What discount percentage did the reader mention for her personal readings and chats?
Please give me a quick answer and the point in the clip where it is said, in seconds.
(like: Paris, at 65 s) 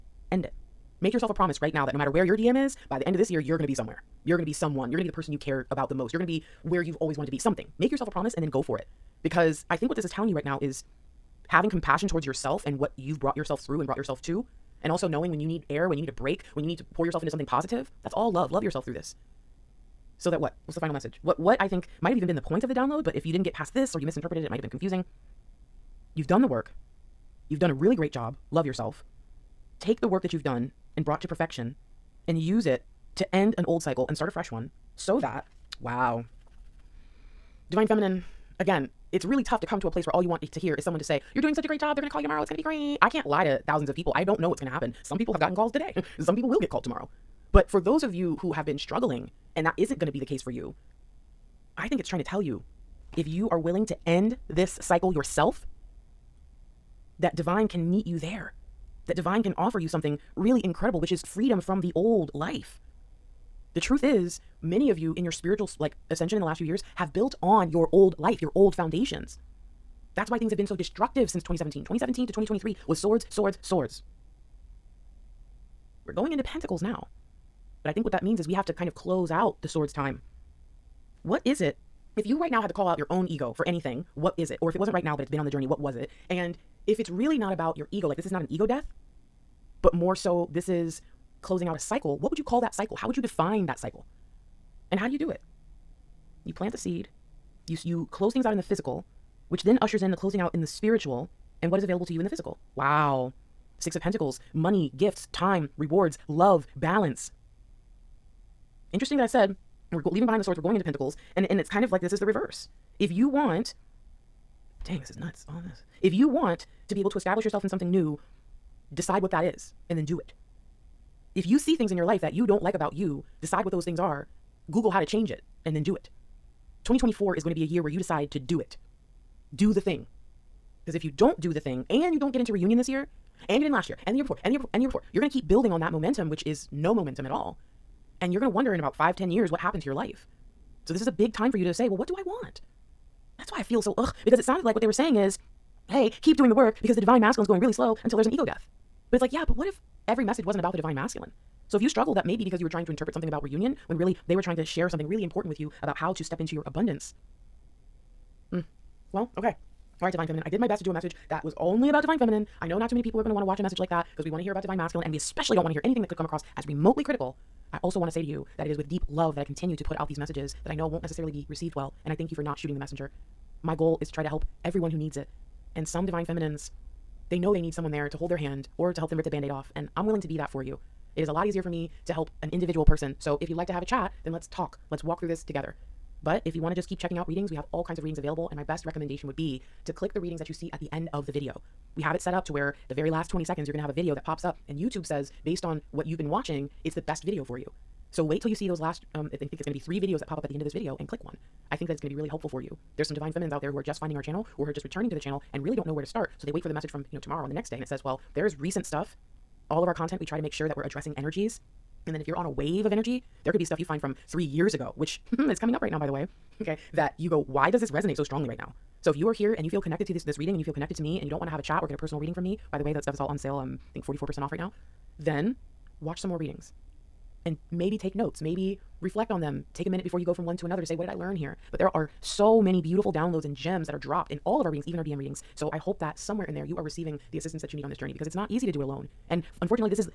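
44%, at 224 s.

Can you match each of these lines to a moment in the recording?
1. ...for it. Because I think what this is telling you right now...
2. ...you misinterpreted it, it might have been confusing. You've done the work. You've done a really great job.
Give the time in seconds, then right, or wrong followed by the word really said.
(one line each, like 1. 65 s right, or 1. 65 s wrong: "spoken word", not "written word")
1. 8 s right
2. 23 s right.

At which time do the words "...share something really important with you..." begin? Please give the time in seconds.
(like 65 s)
154 s.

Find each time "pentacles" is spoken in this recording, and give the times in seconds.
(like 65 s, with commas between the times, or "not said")
76 s, 104 s, 110 s.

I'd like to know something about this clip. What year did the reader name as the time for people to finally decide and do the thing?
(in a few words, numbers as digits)
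2024.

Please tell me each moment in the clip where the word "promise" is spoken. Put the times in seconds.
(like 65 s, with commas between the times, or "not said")
1 s, 8 s.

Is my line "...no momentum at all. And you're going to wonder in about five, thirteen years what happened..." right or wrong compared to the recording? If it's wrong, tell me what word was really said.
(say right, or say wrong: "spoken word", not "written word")
wrong: "ten", not "thirteen".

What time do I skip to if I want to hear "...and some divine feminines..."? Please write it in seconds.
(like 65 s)
175 s.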